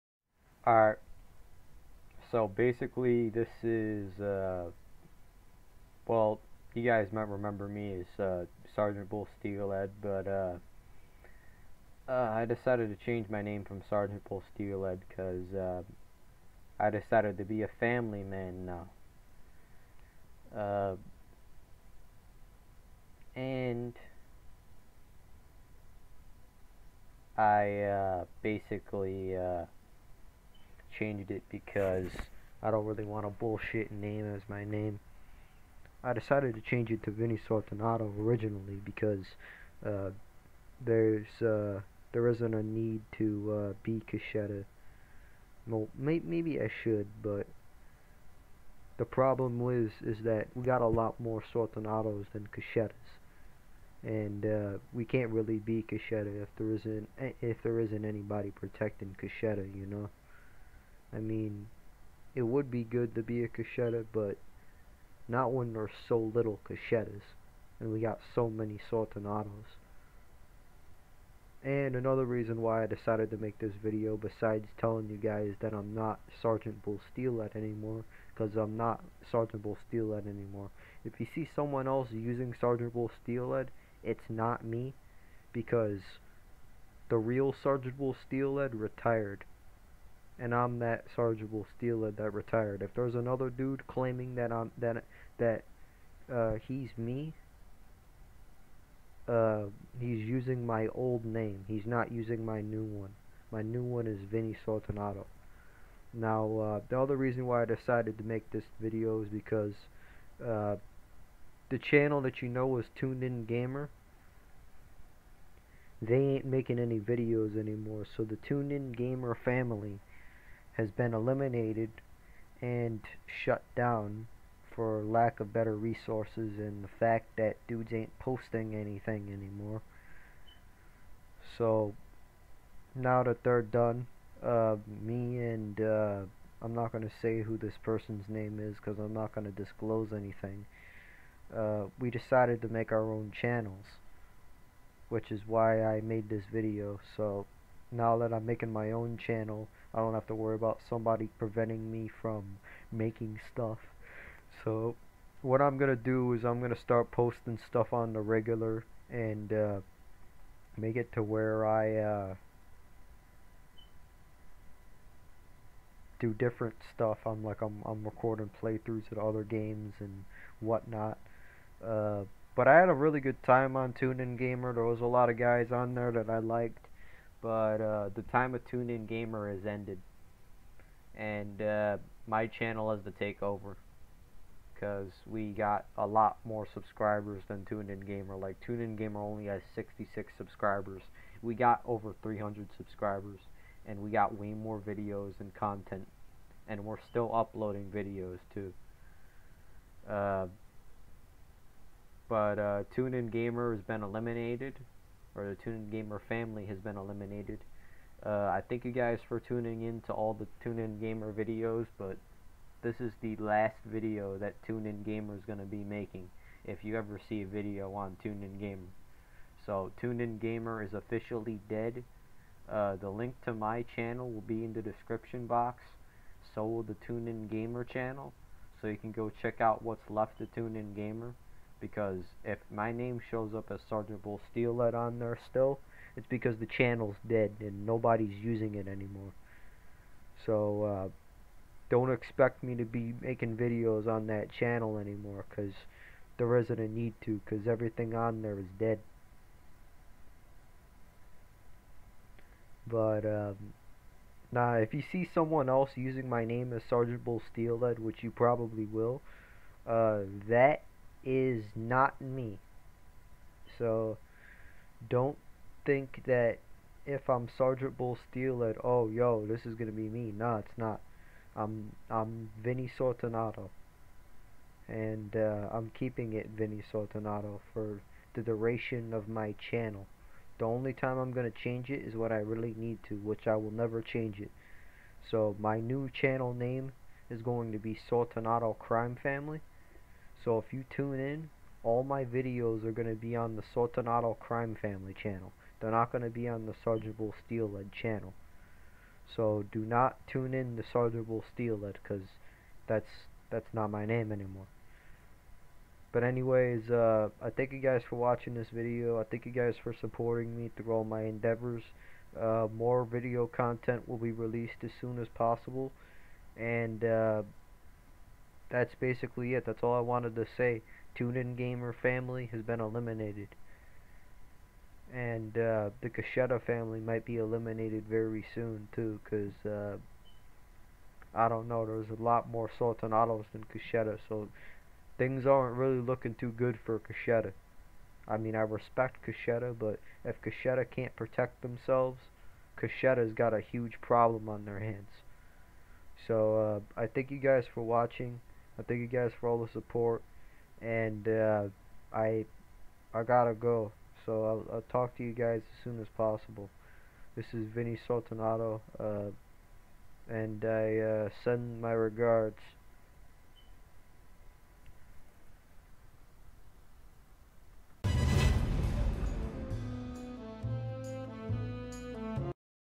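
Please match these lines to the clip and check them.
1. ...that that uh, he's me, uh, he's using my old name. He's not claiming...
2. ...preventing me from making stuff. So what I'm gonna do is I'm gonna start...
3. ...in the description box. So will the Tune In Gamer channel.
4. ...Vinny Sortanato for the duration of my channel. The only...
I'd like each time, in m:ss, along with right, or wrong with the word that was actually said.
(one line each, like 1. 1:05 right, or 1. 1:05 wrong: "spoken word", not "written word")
1. 1:34 wrong: "using", not "claiming"
2. 2:31 right
3. 3:44 right
4. 4:36 right.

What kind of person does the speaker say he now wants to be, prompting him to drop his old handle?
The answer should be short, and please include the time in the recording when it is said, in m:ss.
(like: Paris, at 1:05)
A family man, at 0:17.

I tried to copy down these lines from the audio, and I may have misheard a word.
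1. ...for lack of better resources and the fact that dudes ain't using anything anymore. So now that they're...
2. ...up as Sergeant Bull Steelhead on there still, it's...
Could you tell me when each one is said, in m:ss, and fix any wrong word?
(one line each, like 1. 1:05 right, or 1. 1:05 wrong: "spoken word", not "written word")
1. 2:04 wrong: "posting", not "using"
2. 3:53 right.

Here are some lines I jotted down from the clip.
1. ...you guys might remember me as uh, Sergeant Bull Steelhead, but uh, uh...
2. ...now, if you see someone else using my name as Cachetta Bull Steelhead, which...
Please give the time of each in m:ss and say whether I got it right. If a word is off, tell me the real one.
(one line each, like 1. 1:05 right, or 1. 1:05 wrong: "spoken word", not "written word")
1. 0:06 right
2. 4:14 wrong: "Sergeant", not "Cachetta".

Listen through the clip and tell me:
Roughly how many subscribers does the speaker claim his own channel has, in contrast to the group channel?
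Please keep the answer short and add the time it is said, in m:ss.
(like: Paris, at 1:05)
Over 300, at 3:11.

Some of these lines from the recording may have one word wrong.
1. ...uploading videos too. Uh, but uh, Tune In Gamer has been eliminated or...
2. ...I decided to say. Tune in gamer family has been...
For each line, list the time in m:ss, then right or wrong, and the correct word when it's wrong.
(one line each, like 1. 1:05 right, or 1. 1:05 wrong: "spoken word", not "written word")
1. 3:17 right
2. 5:19 wrong: "wanted", not "decided".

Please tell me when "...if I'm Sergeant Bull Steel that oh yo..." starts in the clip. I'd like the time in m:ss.
4:27.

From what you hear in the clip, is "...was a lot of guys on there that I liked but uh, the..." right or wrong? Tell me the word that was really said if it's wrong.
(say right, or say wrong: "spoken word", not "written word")
right.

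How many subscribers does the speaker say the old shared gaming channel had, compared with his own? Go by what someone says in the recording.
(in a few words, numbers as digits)
66.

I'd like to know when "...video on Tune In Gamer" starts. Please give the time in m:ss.
3:37.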